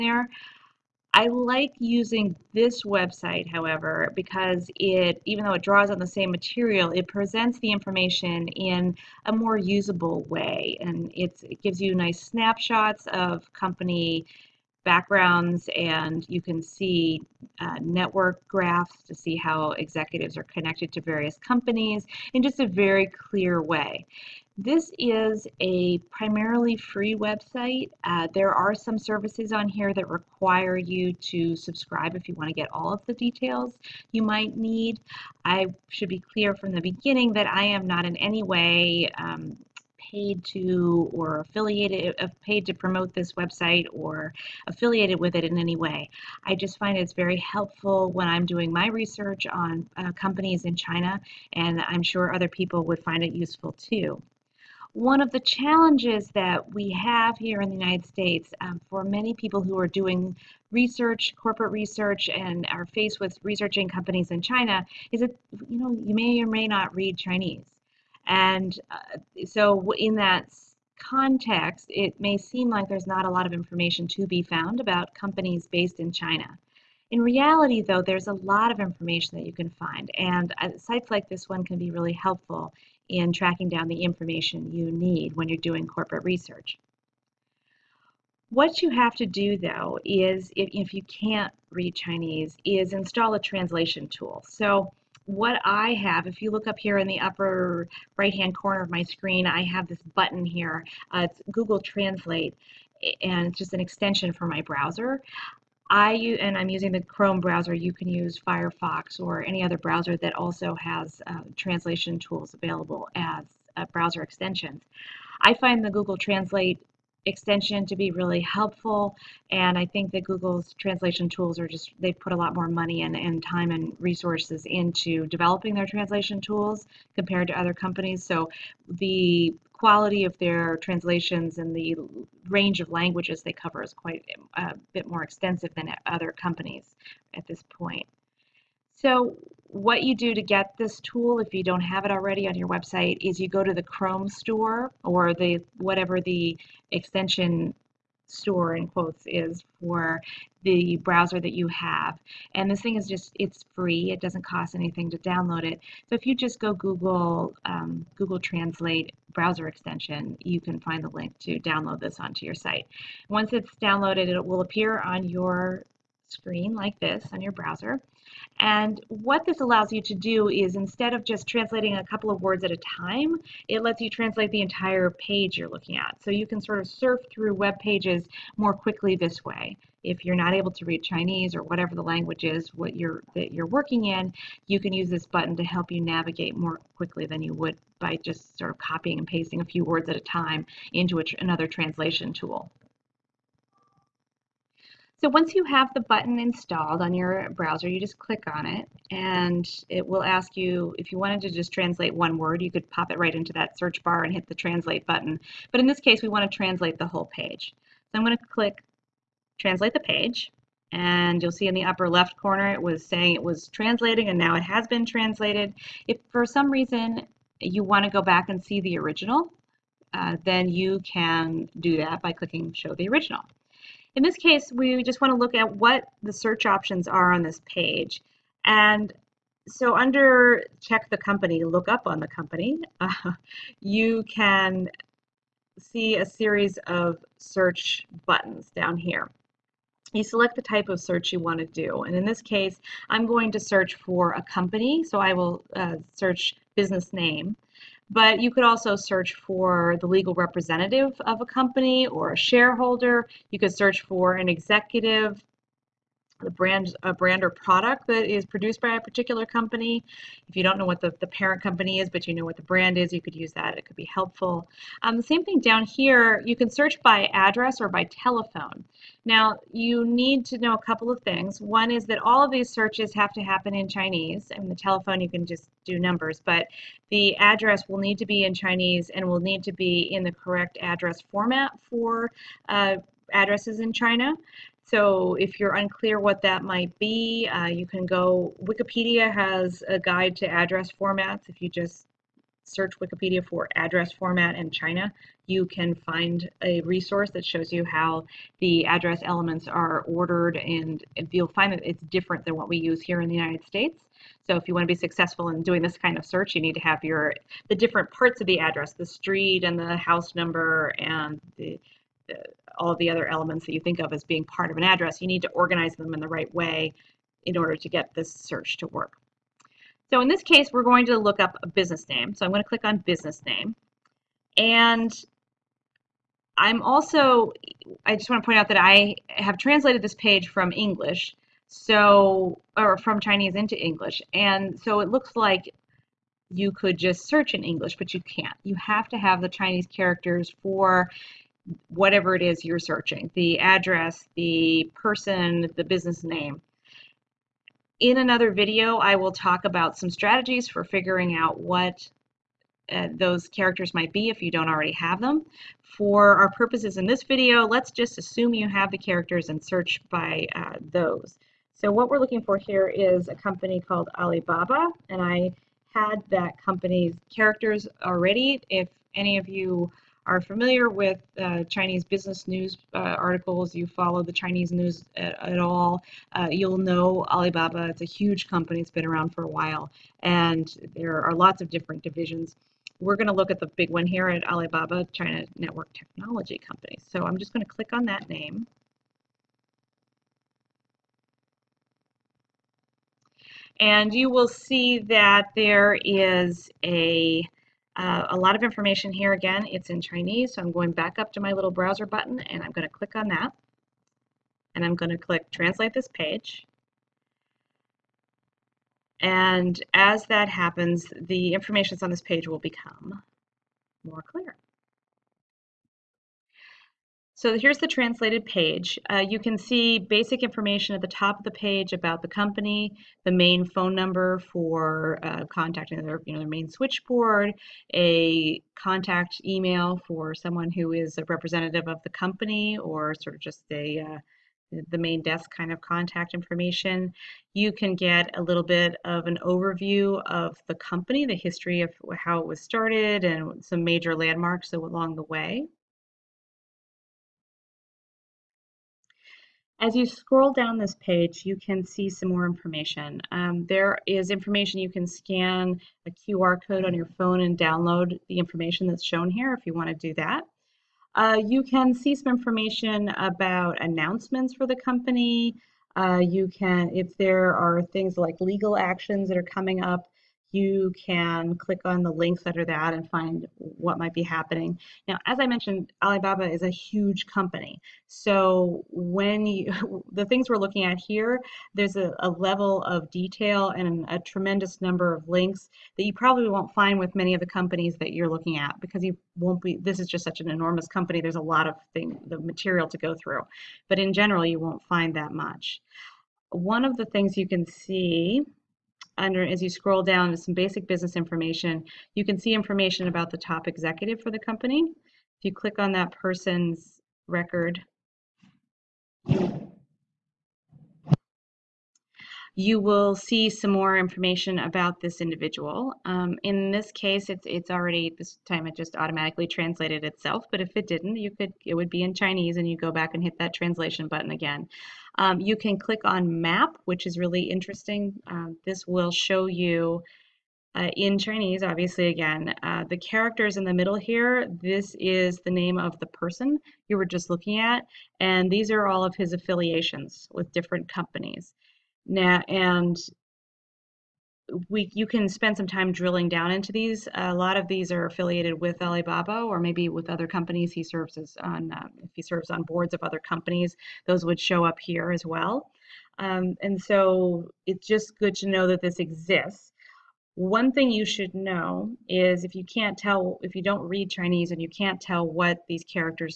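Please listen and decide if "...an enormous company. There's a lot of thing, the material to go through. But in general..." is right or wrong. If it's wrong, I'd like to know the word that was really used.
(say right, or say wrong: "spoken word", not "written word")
right.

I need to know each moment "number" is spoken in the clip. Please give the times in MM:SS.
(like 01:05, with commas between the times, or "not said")
04:36, 05:10, 07:03, 08:04.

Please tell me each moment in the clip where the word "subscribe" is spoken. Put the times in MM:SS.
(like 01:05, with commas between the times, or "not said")
00:31.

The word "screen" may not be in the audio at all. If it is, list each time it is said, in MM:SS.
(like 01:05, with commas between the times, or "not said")
01:39, 02:46.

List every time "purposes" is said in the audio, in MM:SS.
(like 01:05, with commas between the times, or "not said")
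05:56.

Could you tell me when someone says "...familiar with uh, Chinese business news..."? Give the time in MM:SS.
06:10.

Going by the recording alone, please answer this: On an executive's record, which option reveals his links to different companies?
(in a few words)
map.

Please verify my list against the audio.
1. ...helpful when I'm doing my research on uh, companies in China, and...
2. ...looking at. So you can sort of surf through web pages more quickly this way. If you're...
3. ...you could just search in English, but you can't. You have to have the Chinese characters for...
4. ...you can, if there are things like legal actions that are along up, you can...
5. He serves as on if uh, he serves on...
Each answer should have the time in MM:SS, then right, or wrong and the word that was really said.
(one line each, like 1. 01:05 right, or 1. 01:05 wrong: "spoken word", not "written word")
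1. 00:47 right
2. 02:55 right
3. 05:36 right
4. 07:46 wrong: "coming", not "along"
5. 09:10 right.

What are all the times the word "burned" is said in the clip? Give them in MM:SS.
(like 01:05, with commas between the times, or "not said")
not said.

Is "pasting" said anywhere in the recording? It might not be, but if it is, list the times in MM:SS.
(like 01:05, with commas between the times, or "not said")
03:09.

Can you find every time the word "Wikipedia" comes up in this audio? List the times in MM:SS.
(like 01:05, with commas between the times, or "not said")
04:48, 04:52.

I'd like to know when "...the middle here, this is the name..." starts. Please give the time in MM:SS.
08:53.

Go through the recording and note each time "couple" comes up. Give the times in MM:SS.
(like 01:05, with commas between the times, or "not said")
02:52, 04:30.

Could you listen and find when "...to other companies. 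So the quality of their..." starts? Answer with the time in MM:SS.
02:07.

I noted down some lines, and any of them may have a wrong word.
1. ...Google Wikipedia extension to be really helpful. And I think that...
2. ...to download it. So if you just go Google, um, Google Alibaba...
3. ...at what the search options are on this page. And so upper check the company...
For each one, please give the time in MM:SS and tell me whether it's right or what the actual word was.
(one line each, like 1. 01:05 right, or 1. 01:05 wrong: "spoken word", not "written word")
1. 01:55 wrong: "Translate", not "Wikipedia"
2. 02:35 wrong: "Translate", not "Alibaba"
3. 03:45 wrong: "under", not "upper".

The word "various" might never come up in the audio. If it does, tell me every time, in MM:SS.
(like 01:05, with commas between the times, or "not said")
00:21.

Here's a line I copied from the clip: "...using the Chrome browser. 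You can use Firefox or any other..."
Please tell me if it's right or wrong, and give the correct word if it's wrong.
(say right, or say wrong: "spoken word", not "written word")
right.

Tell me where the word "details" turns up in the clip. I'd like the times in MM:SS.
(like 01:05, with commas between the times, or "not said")
00:33, 08:03.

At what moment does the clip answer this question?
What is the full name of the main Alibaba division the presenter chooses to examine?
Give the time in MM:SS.
06:24.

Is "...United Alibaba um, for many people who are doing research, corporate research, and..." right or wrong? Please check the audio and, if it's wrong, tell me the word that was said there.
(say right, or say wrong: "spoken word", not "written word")
wrong: "States", not "Alibaba".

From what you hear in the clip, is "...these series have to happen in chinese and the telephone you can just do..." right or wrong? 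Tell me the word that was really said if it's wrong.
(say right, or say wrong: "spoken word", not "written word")
wrong: "searches", not "series".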